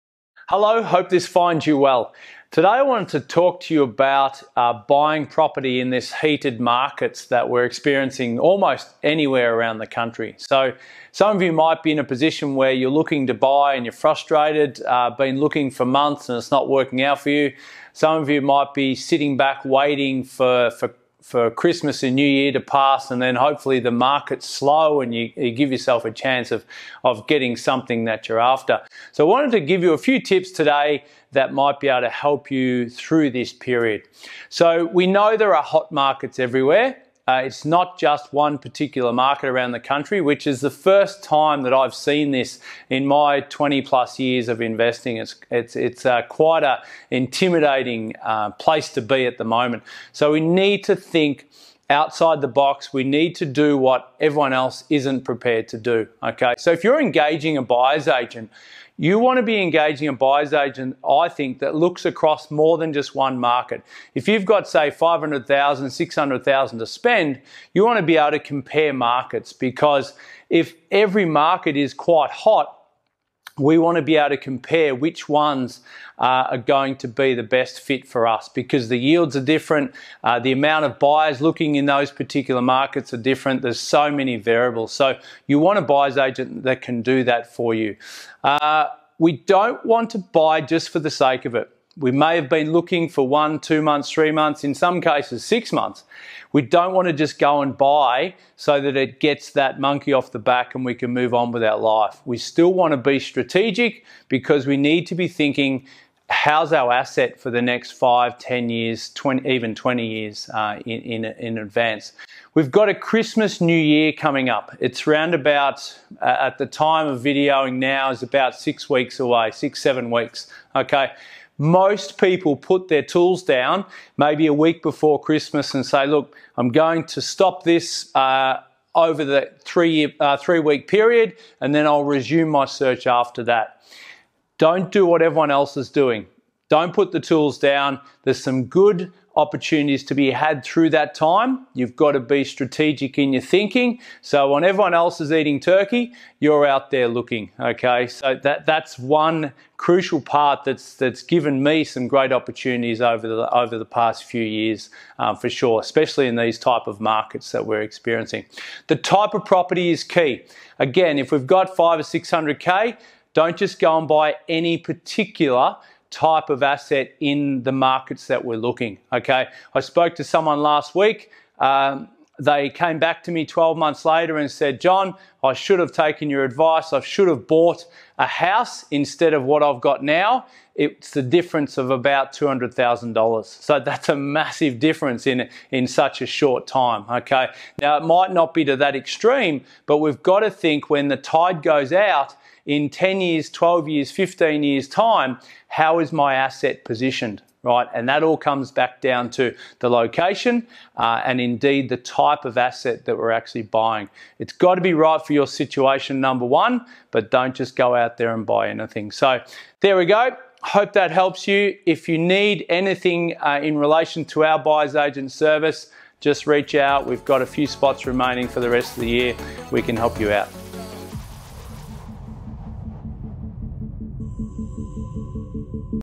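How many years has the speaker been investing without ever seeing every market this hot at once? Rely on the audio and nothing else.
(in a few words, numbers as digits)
20 plus years.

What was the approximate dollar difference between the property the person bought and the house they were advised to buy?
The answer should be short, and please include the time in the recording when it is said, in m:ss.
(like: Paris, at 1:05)
$200,000, at 3:02.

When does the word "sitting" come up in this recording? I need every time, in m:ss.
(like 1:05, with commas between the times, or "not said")
0:18.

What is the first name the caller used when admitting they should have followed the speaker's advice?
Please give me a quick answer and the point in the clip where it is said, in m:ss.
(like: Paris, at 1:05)
John, at 2:54.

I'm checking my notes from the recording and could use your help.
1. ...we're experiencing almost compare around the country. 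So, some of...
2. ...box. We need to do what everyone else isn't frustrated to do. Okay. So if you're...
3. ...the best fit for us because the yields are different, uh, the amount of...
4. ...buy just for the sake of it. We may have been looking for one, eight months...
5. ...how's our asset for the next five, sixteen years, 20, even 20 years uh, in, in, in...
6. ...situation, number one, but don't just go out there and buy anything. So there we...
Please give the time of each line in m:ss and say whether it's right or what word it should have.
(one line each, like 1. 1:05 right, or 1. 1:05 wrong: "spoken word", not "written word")
1. 0:07 wrong: "anywhere", not "compare"
2. 0:52 wrong: "prepared", not "frustrated"
3. 1:17 right
4. 1:30 wrong: "two", not "eight"
5. 1:46 wrong: "ten", not "sixteen"
6. 3:25 right.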